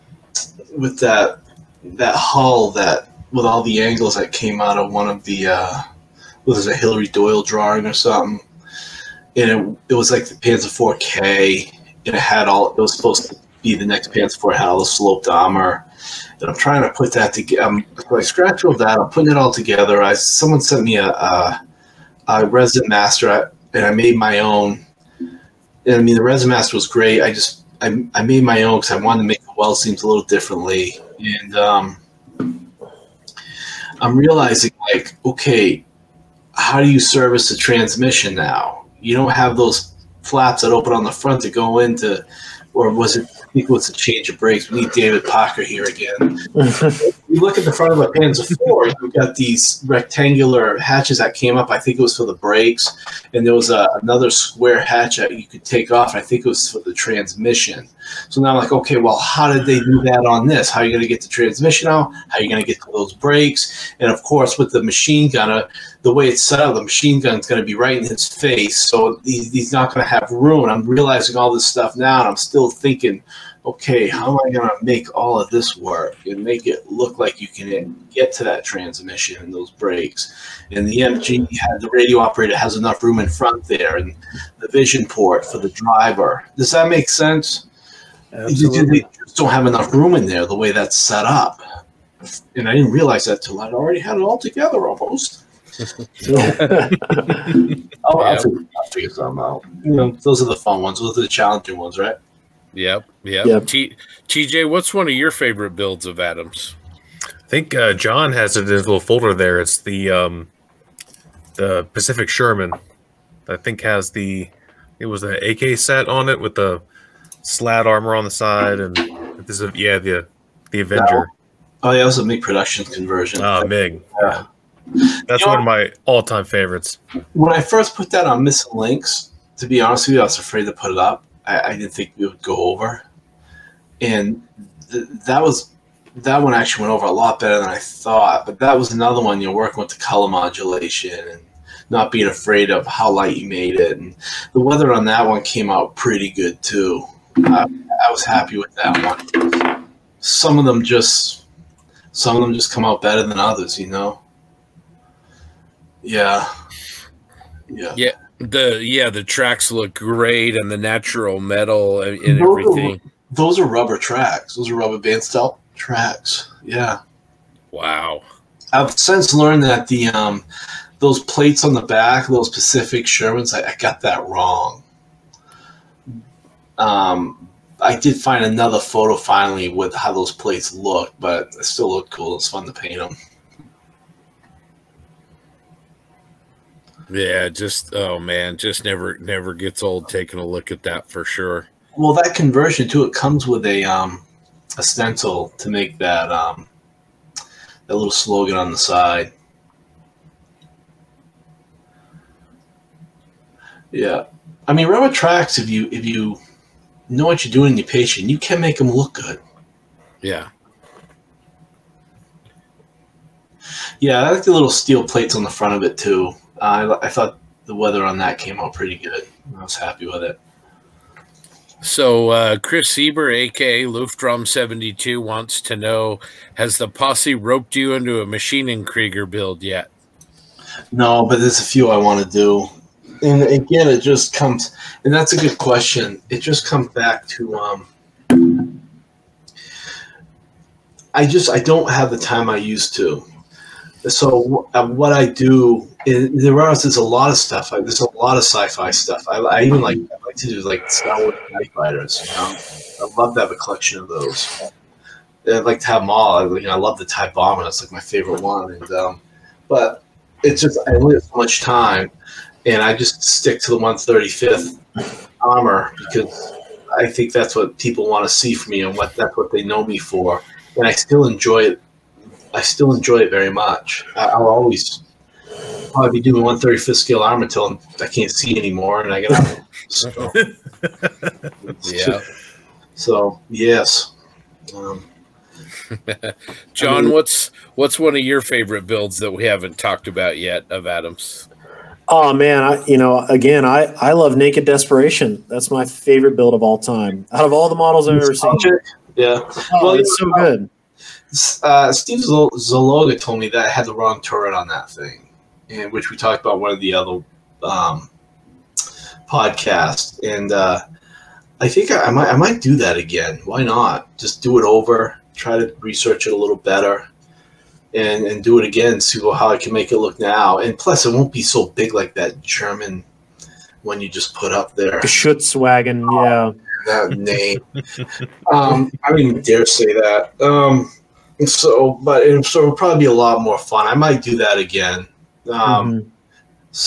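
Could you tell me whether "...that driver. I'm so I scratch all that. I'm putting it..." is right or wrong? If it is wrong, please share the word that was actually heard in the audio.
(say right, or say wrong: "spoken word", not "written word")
wrong: "together", not "driver".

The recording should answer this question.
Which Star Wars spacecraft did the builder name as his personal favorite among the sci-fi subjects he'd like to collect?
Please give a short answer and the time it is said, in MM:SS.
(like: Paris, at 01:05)
Tie bomber, at 04:17.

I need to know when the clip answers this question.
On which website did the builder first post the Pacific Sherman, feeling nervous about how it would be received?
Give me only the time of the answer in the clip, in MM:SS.
02:08.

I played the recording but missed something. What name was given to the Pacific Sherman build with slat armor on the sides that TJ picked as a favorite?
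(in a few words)
Avenger.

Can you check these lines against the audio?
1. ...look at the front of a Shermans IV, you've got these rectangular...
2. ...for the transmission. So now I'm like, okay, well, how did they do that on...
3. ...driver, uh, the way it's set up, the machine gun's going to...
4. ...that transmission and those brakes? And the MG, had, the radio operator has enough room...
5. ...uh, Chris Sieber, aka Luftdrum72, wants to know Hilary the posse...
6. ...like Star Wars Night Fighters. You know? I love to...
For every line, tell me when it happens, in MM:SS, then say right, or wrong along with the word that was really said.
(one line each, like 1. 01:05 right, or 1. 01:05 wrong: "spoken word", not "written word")
1. 00:47 wrong: "Panzer", not "Shermans"
2. 00:56 right
3. 01:05 wrong: "gunner", not "driver"
4. 01:18 right
5. 03:42 wrong: "Has", not "Hilary"
6. 04:10 right.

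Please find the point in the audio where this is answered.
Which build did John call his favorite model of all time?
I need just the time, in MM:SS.
04:54.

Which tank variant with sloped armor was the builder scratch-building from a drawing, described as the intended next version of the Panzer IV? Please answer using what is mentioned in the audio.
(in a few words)
Panzer 4K.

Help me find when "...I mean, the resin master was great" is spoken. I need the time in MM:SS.
00:25.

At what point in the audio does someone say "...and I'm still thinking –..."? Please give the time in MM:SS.
01:12.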